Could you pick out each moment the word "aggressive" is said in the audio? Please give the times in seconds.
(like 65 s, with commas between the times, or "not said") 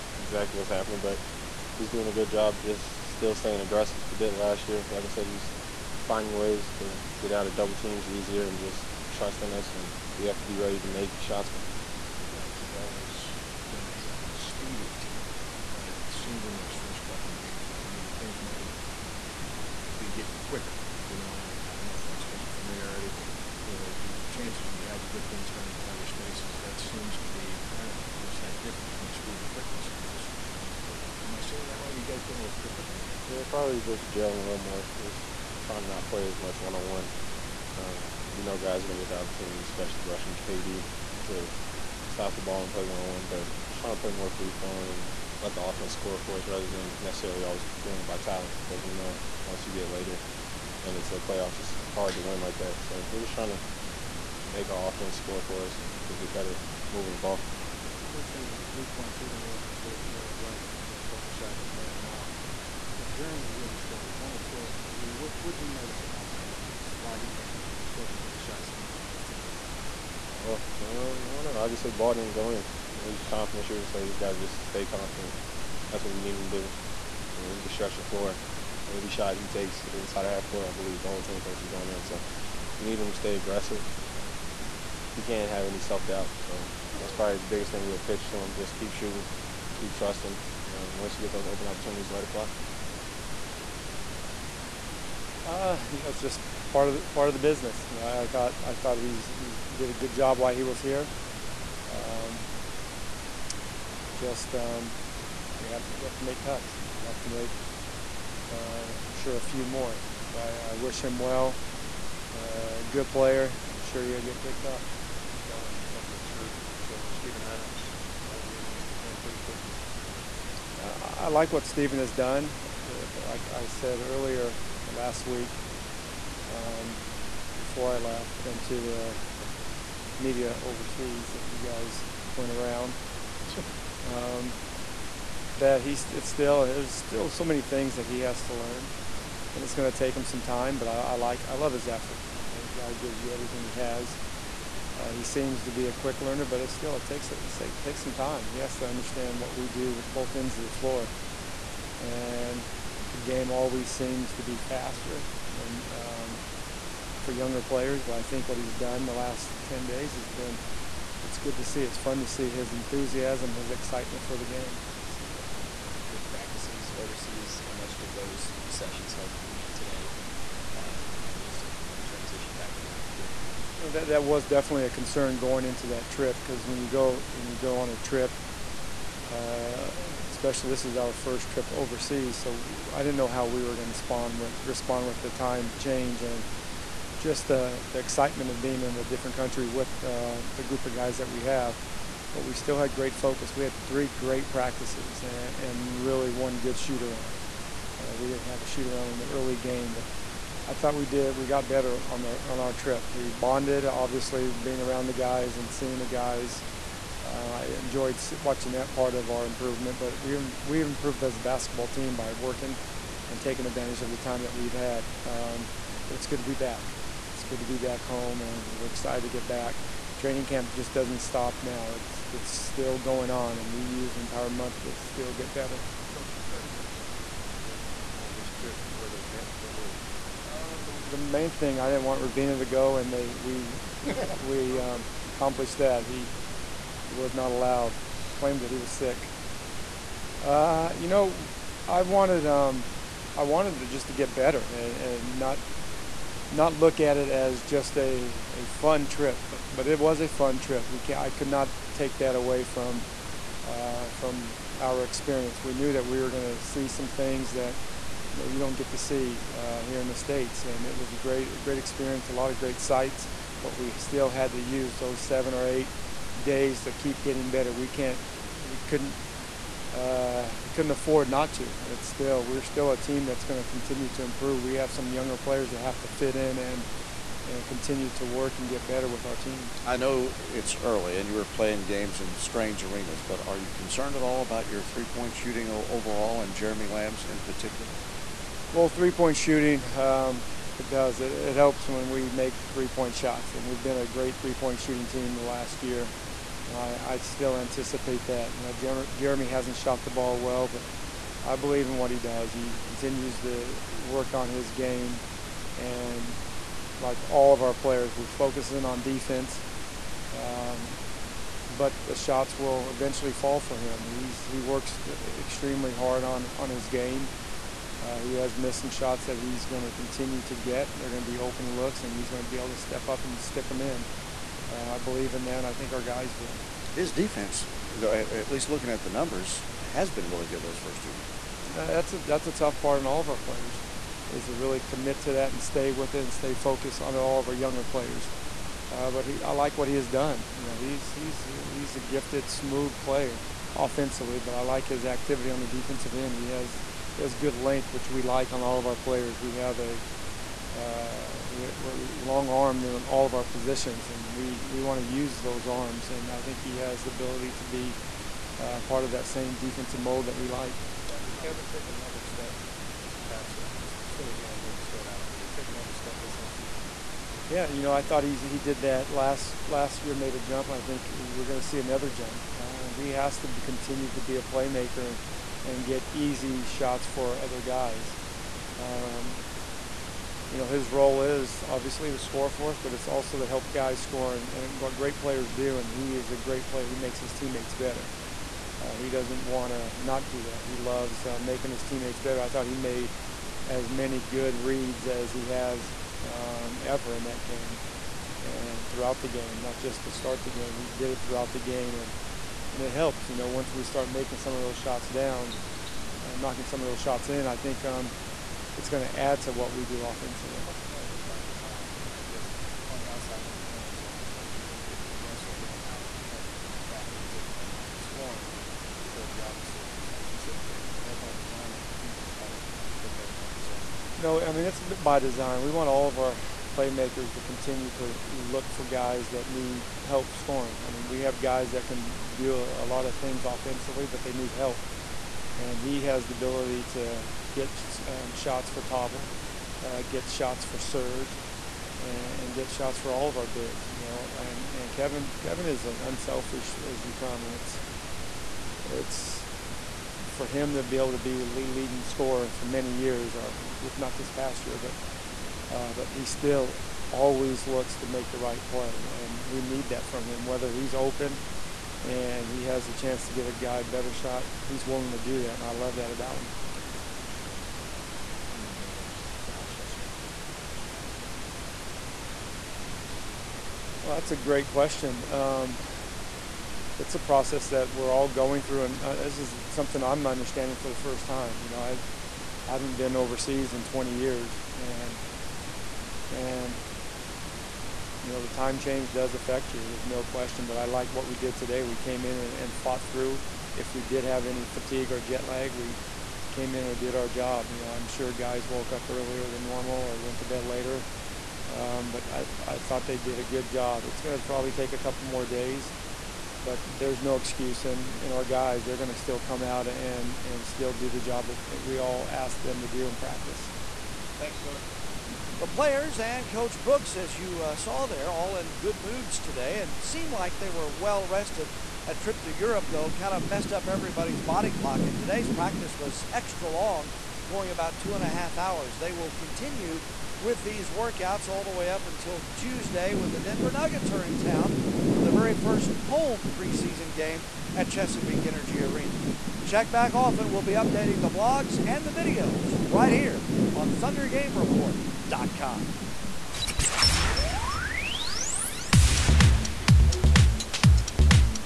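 3 s, 83 s.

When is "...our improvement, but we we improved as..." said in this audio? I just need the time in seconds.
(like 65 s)
209 s.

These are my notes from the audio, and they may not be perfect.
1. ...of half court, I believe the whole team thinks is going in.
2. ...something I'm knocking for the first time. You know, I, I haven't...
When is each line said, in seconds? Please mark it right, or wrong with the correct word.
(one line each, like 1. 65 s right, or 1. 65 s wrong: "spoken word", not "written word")
1. 80 s right
2. 479 s wrong: "understanding", not "knocking".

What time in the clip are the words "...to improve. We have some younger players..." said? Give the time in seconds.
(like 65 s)
274 s.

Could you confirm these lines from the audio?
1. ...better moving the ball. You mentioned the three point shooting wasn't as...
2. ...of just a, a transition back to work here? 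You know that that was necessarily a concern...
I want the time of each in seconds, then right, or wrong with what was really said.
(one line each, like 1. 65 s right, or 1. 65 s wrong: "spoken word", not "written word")
1. 56 s right
2. 171 s wrong: "definitely", not "necessarily".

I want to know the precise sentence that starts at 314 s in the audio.
He's he works uh, extremely hard on on his game.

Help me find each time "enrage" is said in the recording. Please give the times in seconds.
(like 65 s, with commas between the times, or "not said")
not said.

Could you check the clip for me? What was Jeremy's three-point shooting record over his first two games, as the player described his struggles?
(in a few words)
1 of 12.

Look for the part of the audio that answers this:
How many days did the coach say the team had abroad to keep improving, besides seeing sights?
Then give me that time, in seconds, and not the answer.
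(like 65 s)
265 s.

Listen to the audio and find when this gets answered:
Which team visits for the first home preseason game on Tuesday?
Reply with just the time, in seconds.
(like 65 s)
533 s.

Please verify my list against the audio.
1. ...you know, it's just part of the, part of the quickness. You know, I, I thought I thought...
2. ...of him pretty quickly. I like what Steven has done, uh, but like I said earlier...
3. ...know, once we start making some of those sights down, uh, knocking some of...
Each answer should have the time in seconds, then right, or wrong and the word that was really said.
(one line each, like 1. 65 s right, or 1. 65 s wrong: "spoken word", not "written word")
1. 95 s wrong: "business", not "quickness"
2. 118 s right
3. 403 s wrong: "shots", not "sights".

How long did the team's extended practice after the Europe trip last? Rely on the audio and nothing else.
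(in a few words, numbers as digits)
2.5 hours.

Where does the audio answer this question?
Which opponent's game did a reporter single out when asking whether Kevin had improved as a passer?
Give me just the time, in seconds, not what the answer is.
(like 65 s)
364 s.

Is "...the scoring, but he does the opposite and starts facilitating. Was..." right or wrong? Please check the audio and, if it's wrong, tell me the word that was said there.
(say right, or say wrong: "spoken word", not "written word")
right.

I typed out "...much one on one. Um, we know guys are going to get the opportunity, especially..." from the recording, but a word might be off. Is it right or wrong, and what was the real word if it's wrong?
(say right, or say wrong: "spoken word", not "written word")
right.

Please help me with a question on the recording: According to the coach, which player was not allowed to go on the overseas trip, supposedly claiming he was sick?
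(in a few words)
Ravina.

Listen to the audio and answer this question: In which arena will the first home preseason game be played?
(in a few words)
Chesapeake Energy Arena.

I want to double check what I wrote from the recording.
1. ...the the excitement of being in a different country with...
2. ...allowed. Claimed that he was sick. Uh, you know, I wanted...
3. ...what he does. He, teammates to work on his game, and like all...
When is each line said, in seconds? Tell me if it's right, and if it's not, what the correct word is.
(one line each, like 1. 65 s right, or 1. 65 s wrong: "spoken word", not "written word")
1. 187 s right
2. 237 s right
3. 301 s wrong: "continues", not "teammates".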